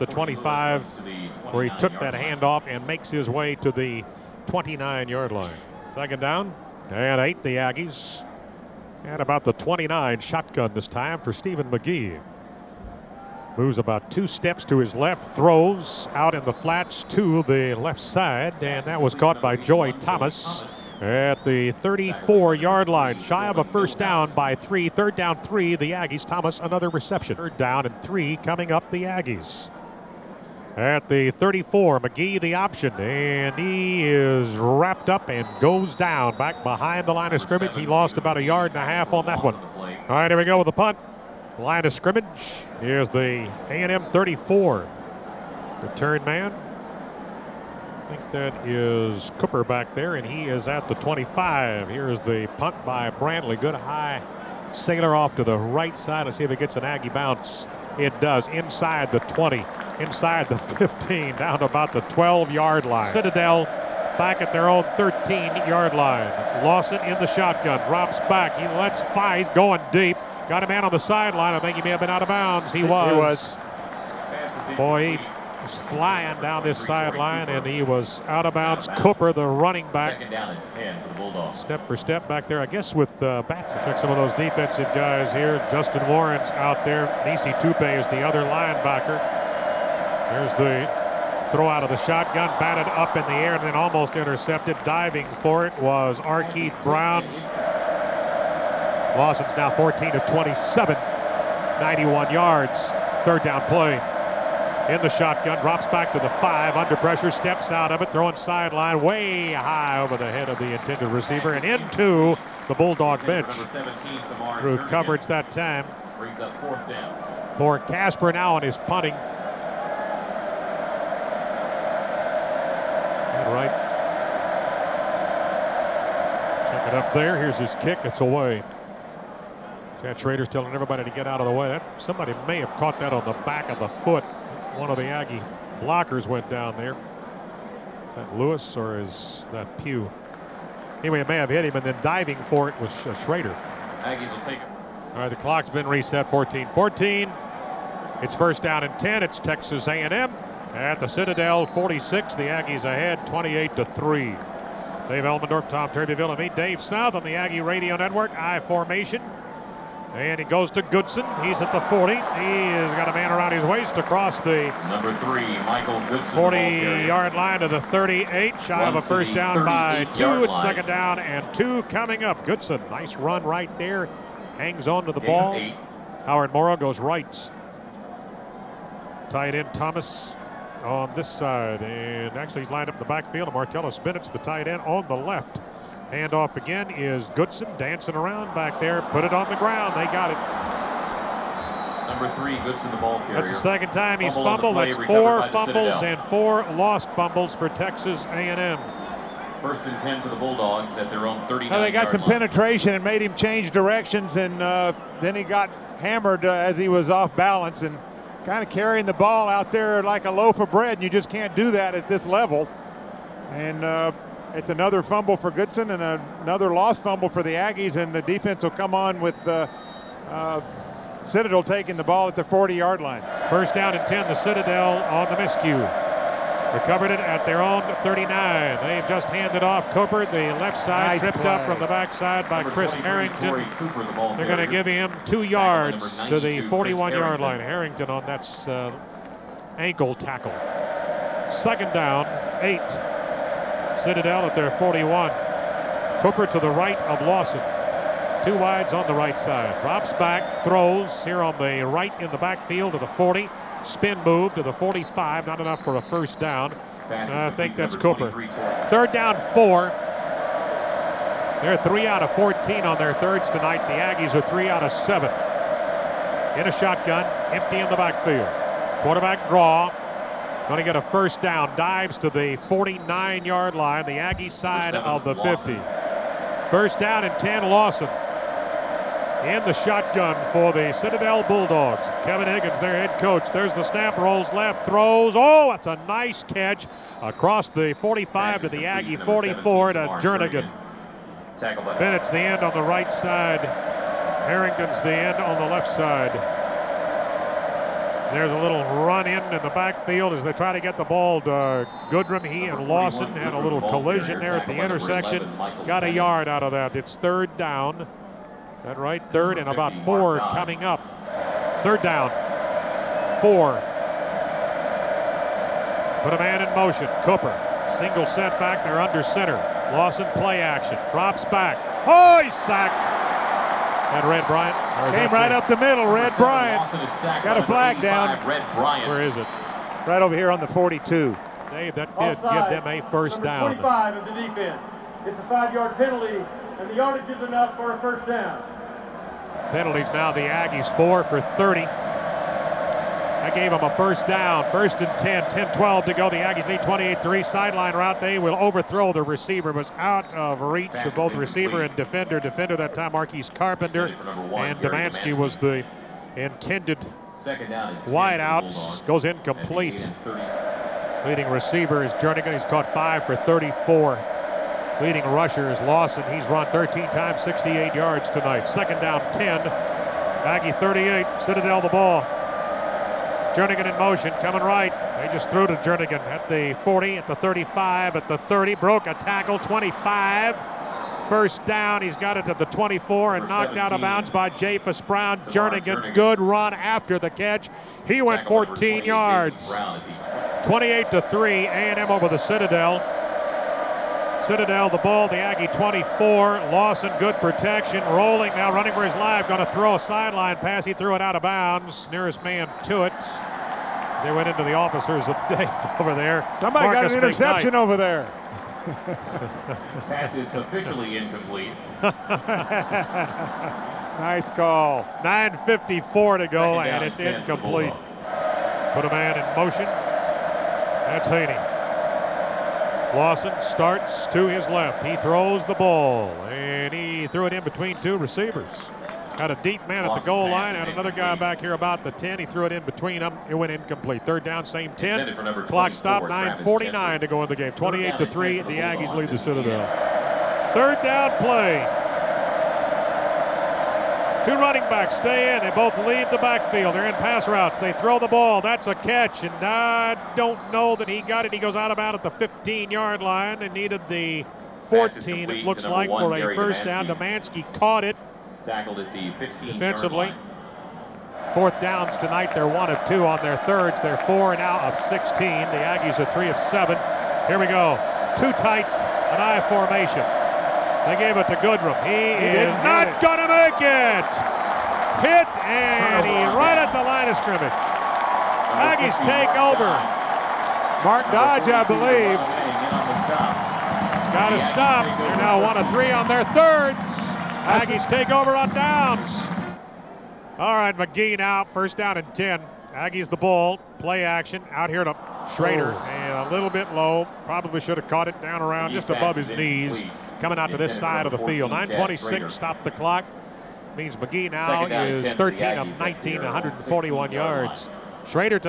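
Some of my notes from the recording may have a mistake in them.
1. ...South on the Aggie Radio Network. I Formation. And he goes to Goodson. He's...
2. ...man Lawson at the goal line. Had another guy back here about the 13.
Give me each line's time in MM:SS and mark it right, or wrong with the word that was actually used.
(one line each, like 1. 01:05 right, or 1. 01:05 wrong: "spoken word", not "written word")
1. 02:36 right
2. 07:09 wrong: "10", not "13".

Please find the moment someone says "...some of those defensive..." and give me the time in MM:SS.
01:23.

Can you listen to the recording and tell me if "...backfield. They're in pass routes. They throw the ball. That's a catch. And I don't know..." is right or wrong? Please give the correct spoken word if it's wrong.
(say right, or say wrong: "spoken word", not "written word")
right.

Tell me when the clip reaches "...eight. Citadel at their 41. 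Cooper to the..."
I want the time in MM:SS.
04:02.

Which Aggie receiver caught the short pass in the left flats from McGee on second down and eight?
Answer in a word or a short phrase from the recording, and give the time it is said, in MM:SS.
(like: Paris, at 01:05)
Joy Thomas, at 00:19.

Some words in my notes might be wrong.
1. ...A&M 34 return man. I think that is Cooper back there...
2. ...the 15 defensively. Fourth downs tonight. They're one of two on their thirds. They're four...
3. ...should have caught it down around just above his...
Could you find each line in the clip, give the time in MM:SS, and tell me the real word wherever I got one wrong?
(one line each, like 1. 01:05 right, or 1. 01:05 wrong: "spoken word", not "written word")
1. 00:43 right
2. 07:39 right
3. 08:17 right.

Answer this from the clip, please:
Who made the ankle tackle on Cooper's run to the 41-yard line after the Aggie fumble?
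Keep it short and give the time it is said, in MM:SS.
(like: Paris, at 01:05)
Chris Harrington, at 03:52.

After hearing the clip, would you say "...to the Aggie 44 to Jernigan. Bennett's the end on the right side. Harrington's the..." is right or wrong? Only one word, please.
right.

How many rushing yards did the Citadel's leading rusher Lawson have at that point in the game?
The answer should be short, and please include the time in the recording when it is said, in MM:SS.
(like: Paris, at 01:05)
68, at 06:07.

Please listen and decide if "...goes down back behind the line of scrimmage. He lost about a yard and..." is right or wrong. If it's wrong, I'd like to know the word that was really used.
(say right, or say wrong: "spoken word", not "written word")
right.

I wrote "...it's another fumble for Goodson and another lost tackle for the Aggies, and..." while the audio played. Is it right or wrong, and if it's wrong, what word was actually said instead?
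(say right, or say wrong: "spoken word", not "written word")
wrong: "fumble", not "tackle".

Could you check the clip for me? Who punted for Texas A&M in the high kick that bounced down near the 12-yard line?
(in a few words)
Brantley.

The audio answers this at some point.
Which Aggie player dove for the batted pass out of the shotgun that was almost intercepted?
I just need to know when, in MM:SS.
01:36.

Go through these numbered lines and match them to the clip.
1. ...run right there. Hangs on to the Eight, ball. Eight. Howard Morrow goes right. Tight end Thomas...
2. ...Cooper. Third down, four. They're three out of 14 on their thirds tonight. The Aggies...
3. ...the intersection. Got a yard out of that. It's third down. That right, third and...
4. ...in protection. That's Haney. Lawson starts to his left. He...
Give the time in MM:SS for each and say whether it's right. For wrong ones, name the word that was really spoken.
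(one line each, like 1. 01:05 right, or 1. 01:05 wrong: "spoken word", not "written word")
1. 02:53 right
2. 04:17 right
3. 05:04 right
4. 06:59 wrong: "motion", not "protection".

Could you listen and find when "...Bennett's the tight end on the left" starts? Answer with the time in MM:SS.
03:04.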